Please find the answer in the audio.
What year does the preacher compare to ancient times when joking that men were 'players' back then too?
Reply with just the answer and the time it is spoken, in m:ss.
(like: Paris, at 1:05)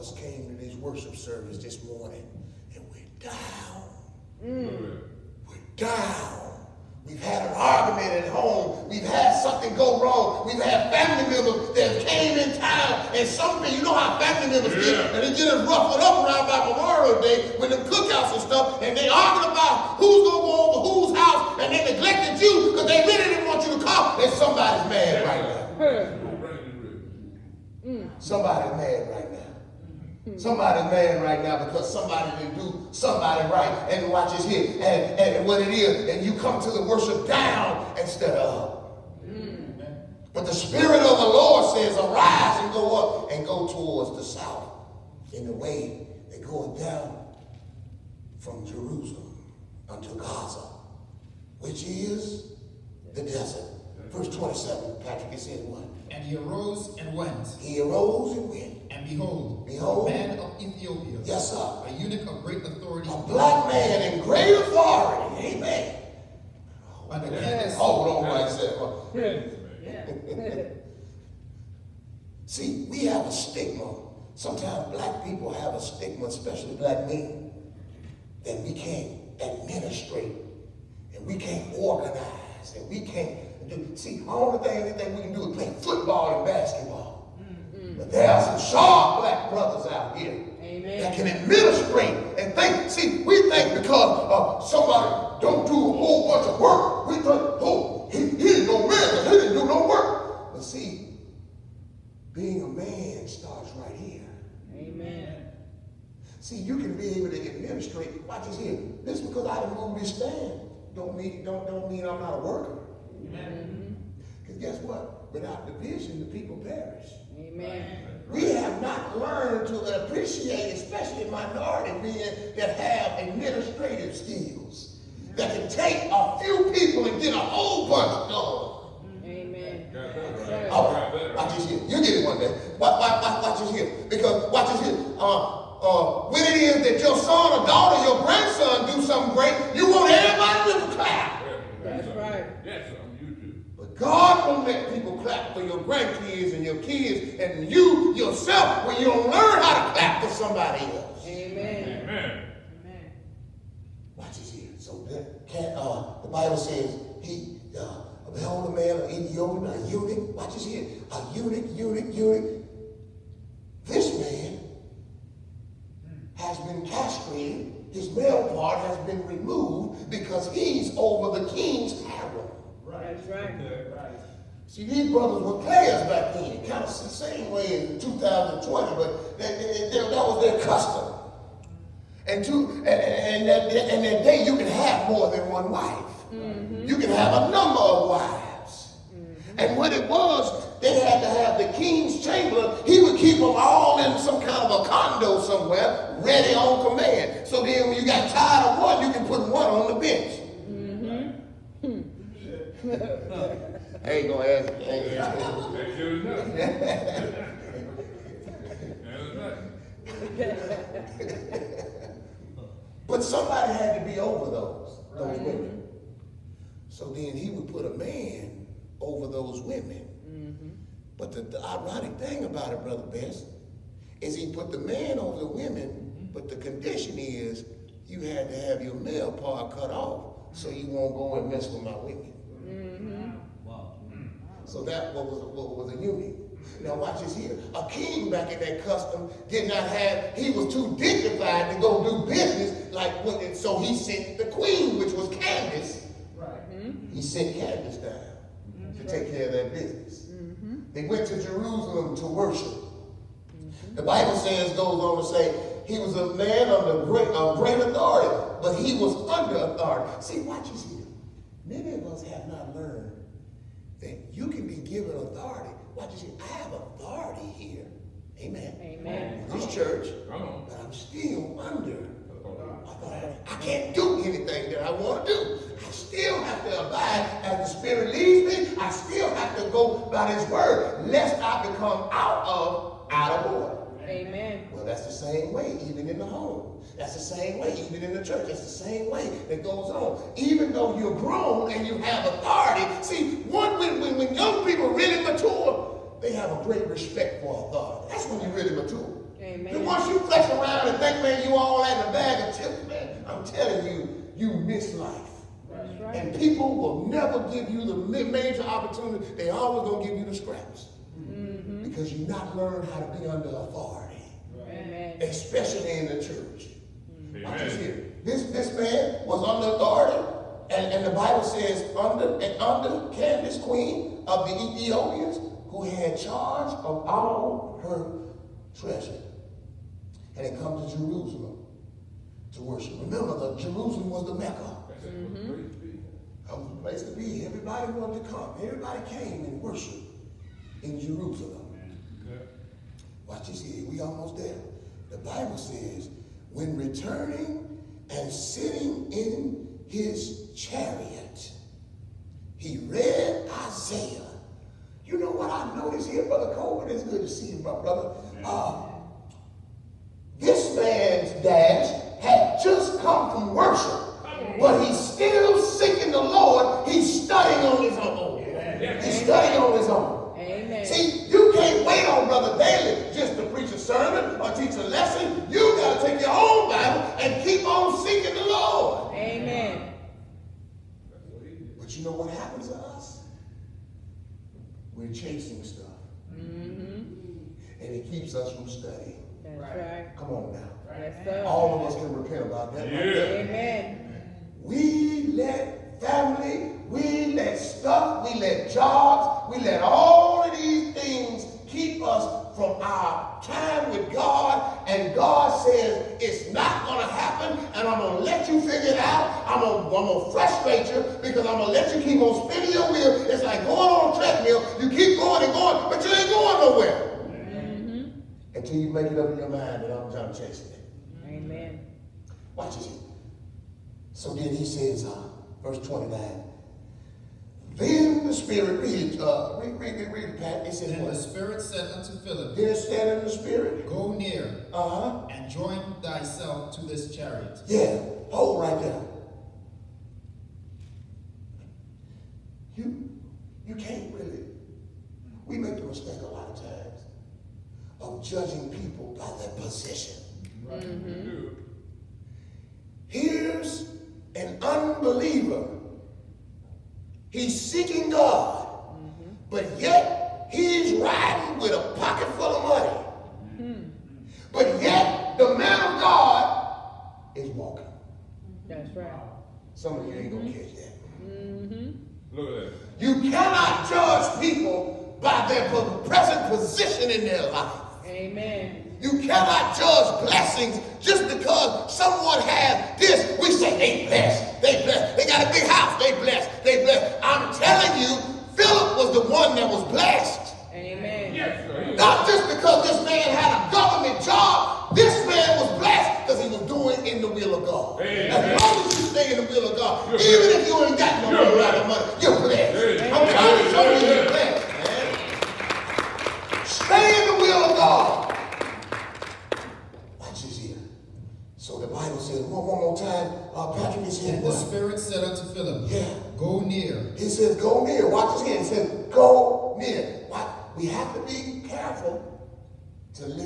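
2020, at 2:57.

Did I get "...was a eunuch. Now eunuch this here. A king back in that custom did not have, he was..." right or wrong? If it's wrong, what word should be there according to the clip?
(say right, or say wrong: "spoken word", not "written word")
wrong: "watch", not "eunuch".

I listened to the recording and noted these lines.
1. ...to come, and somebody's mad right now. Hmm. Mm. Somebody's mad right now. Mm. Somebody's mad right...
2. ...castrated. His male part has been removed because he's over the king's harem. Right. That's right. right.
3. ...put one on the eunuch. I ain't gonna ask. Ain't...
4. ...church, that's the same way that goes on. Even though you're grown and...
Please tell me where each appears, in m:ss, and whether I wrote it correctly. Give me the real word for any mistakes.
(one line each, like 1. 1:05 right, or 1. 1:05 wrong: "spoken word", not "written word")
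1. 0:23 right
2. 2:46 right
3. 3:19 wrong: "bench", not "eunuch"
4. 4:48 right.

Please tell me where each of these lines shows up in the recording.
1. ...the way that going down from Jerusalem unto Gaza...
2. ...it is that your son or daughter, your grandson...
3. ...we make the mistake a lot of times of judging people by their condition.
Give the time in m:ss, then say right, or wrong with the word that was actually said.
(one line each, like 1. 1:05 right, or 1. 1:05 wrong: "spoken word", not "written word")
1. 0:45 right
2. 2:16 right
3. 7:25 wrong: "position", not "condition".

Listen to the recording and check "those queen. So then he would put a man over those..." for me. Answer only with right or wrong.
wrong.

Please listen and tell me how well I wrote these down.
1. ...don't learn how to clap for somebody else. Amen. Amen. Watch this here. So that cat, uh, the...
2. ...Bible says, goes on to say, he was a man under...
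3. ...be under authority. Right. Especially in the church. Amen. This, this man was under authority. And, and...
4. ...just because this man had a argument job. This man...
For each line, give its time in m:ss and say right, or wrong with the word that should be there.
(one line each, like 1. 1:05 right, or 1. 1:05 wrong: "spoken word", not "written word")
1. 2:29 right
2. 4:14 right
3. 5:13 right
4. 8:12 wrong: "government", not "argument".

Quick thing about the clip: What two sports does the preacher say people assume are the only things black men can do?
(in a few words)
football and basketball.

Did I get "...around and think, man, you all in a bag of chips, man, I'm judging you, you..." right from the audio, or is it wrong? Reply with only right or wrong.
wrong.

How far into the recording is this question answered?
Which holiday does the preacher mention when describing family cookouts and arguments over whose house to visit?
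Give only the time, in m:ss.
0:16.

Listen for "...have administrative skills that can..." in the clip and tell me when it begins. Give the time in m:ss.
2:02.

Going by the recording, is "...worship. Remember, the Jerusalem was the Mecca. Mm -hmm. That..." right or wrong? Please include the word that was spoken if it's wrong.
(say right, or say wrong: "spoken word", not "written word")
right.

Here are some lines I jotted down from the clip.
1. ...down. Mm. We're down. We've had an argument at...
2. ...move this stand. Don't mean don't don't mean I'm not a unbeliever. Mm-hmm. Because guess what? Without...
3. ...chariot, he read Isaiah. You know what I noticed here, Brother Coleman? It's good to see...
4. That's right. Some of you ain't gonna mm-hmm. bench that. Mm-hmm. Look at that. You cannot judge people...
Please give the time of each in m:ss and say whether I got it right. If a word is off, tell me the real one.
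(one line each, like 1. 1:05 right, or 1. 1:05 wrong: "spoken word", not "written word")
1. 0:03 right
2. 1:49 wrong: "worker", not "unbeliever"
3. 5:50 right
4. 7:48 wrong: "catch", not "bench".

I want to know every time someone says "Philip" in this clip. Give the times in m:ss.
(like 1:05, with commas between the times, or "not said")
7:12, 8:08, 8:35.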